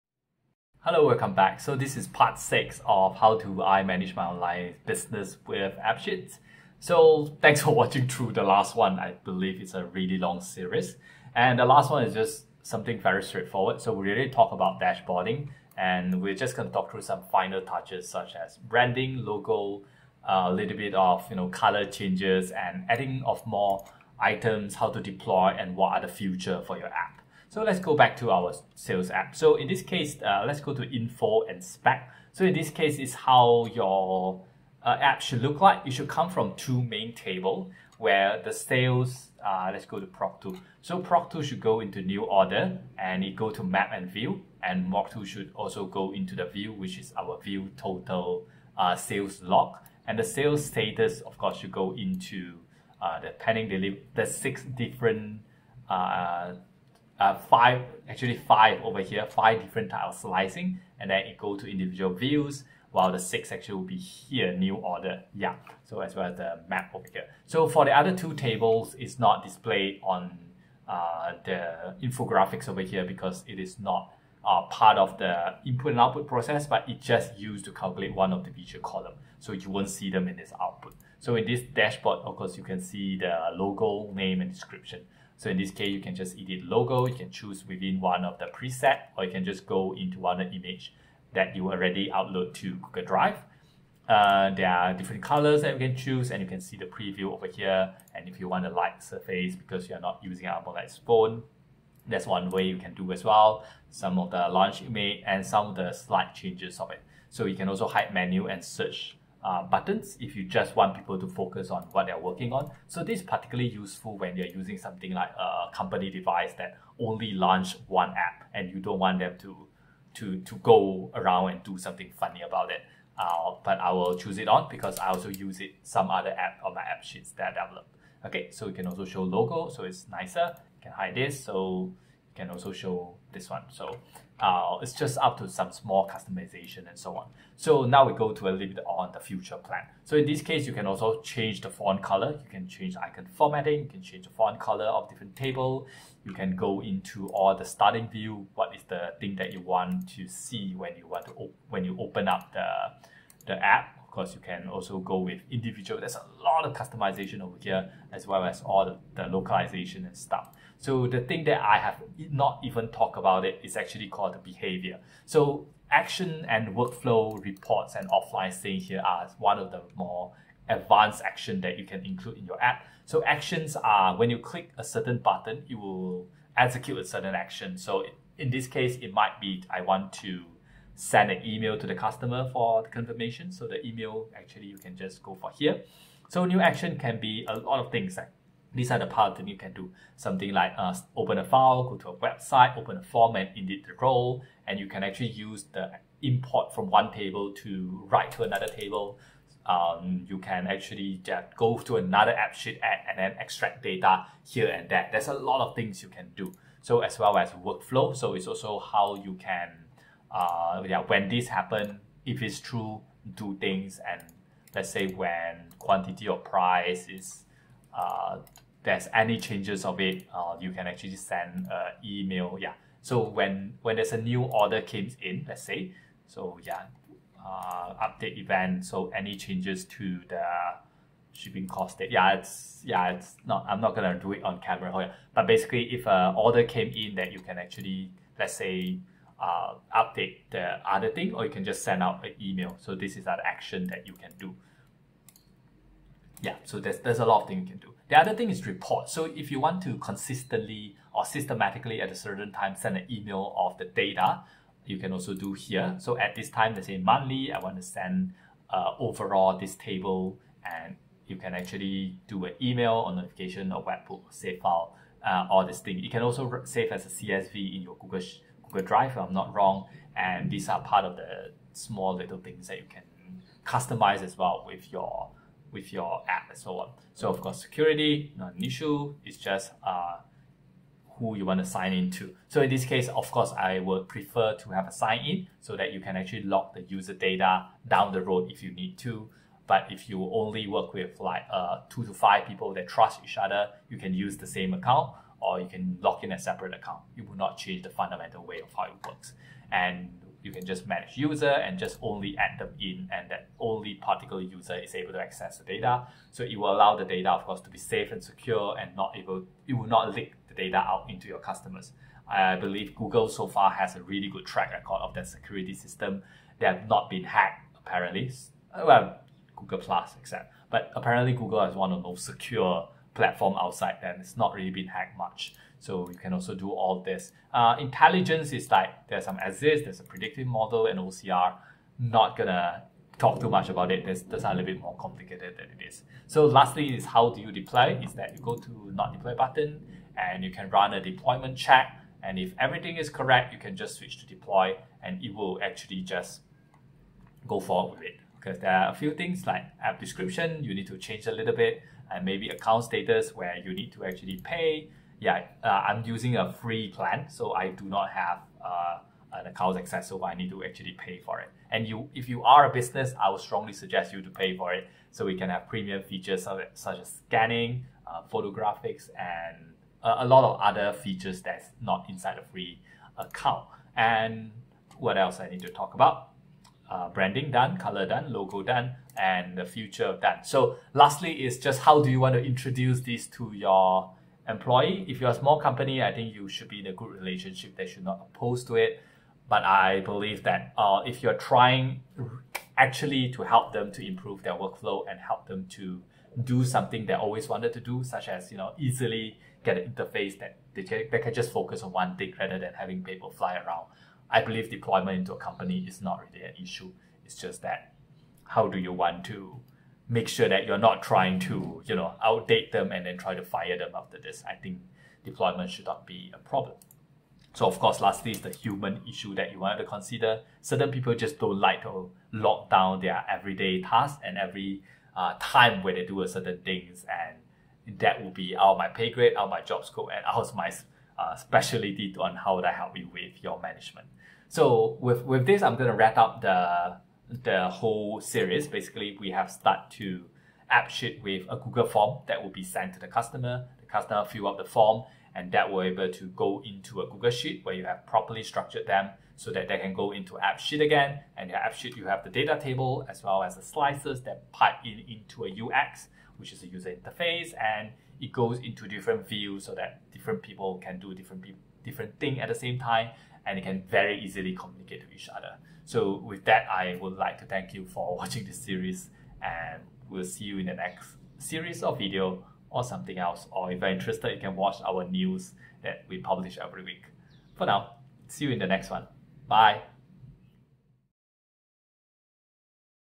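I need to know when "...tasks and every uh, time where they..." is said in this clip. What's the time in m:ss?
7:03.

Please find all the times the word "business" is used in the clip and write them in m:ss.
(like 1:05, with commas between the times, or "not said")
0:04, 6:02.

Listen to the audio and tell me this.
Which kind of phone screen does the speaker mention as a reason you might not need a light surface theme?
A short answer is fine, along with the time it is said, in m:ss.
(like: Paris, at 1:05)
AMOLED, at 1:40.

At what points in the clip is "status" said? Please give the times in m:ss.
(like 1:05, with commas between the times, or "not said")
0:50, 5:52.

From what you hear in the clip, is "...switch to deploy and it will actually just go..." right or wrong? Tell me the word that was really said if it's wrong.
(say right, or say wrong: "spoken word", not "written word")
right.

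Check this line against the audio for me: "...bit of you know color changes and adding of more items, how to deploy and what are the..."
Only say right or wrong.
right.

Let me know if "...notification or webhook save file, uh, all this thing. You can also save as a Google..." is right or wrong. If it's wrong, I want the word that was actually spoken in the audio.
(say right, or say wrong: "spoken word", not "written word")
wrong: "CSV", not "Google".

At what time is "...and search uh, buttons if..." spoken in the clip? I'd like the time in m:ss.
1:48.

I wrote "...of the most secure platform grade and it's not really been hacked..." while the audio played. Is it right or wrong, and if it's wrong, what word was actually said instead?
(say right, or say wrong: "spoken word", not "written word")
wrong: "outside", not "grade".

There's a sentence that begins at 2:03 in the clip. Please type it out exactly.
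Uh, but I will choose it on because I also use it some other app on my app sheets that I develop.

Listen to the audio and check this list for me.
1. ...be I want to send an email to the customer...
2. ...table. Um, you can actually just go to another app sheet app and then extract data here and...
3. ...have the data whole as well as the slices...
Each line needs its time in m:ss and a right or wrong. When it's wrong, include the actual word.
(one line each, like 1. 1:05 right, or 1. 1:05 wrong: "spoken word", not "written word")
1. 2:59 right
2. 3:18 right
3. 7:32 wrong: "table", not "whole".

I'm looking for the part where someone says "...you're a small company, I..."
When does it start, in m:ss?
6:25.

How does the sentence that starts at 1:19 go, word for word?
So you won't see them in this output.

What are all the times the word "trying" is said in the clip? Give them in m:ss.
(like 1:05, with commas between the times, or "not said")
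6:31, 6:51.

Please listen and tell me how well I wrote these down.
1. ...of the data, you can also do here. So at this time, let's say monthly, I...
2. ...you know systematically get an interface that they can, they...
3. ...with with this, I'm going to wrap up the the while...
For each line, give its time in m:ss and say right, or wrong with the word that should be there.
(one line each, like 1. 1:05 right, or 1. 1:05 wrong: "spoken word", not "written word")
1. 4:13 right
2. 6:38 wrong: "easily", not "systematically"
3. 7:15 wrong: "whole", not "while".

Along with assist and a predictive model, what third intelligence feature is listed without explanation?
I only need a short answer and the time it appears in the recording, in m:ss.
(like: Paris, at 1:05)
OCR, at 5:30.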